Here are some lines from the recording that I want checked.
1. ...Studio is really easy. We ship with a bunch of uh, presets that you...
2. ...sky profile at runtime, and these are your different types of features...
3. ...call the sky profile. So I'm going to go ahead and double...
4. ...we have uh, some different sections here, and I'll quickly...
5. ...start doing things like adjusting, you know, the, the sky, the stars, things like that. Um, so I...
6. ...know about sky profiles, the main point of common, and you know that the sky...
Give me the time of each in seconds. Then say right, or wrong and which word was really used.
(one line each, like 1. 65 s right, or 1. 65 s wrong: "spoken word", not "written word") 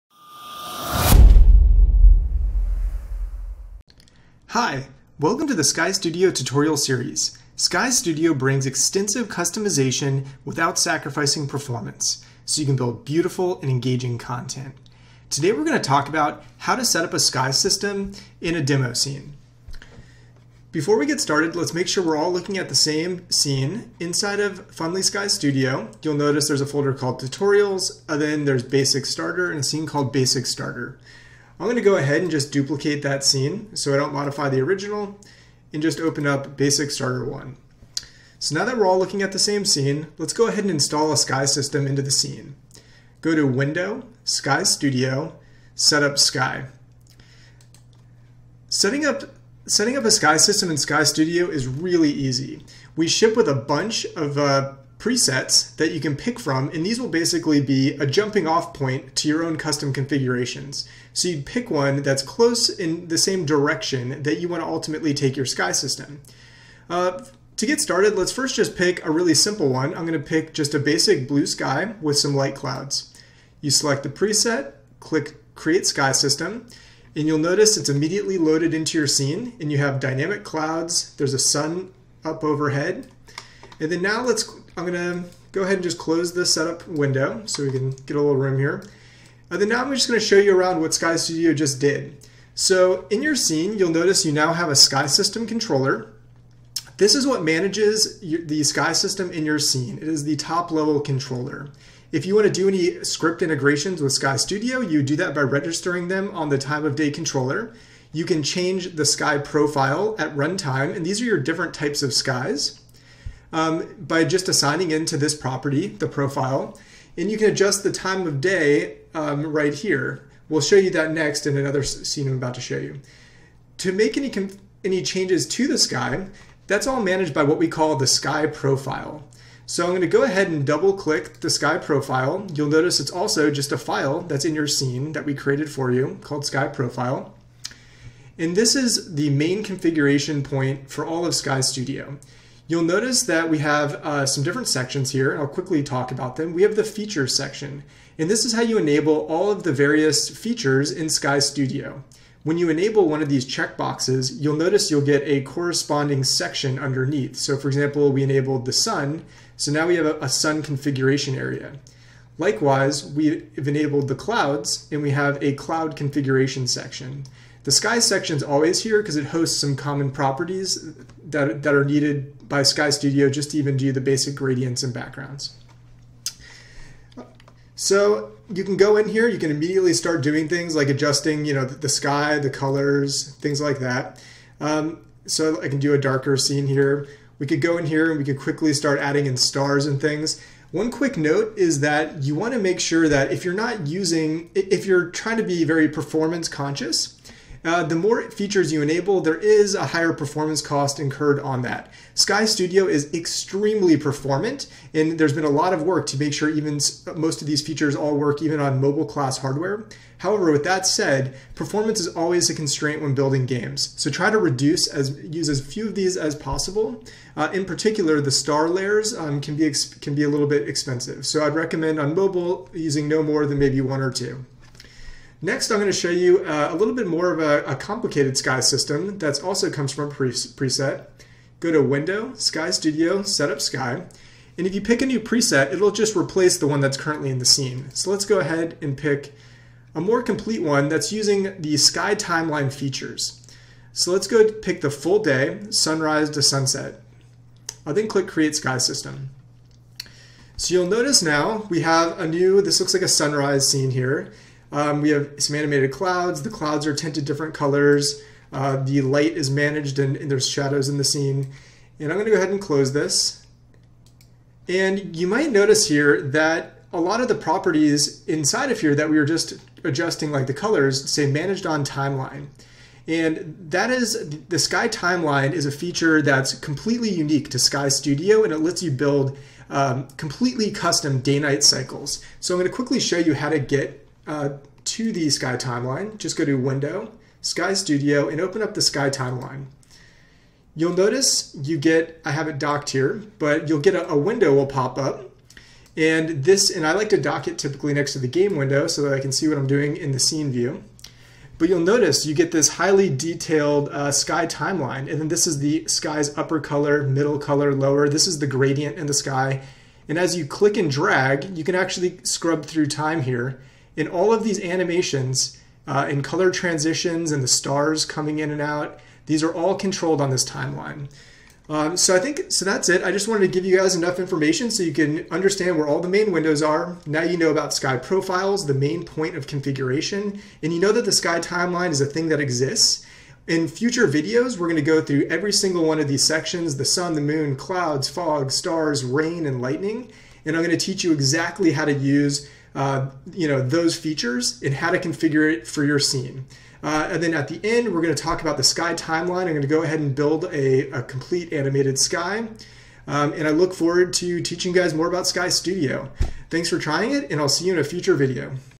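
1. 51 s right
2. 109 s wrong: "skies", not "features"
3. 127 s right
4. 143 s right
5. 179 s wrong: "colors", not "stars"
6. 327 s wrong: "configuration", not "common".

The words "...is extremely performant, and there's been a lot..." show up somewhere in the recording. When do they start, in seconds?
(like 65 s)
202 s.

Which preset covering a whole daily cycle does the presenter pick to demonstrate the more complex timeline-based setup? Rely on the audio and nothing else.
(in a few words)
full day, sunrise to sunset.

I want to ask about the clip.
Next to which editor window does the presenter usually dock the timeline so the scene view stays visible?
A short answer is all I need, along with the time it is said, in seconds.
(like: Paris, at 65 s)
game window, at 298 s.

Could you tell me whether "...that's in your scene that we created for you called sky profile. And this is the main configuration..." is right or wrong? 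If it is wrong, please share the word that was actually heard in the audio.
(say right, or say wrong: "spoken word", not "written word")
right.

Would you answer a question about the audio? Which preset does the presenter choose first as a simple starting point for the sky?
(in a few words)
basic blue sky.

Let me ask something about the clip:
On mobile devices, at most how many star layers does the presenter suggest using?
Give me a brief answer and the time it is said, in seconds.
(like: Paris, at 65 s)
2, at 224 s.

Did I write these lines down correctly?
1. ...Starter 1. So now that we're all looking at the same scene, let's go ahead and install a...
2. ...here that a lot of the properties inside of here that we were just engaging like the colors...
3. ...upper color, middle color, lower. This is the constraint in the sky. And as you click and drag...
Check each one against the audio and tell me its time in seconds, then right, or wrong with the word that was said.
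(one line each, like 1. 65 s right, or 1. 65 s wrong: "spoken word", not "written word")
1. 36 s right
2. 265 s wrong: "adjusting", not "engaging"
3. 306 s wrong: "gradient", not "constraint".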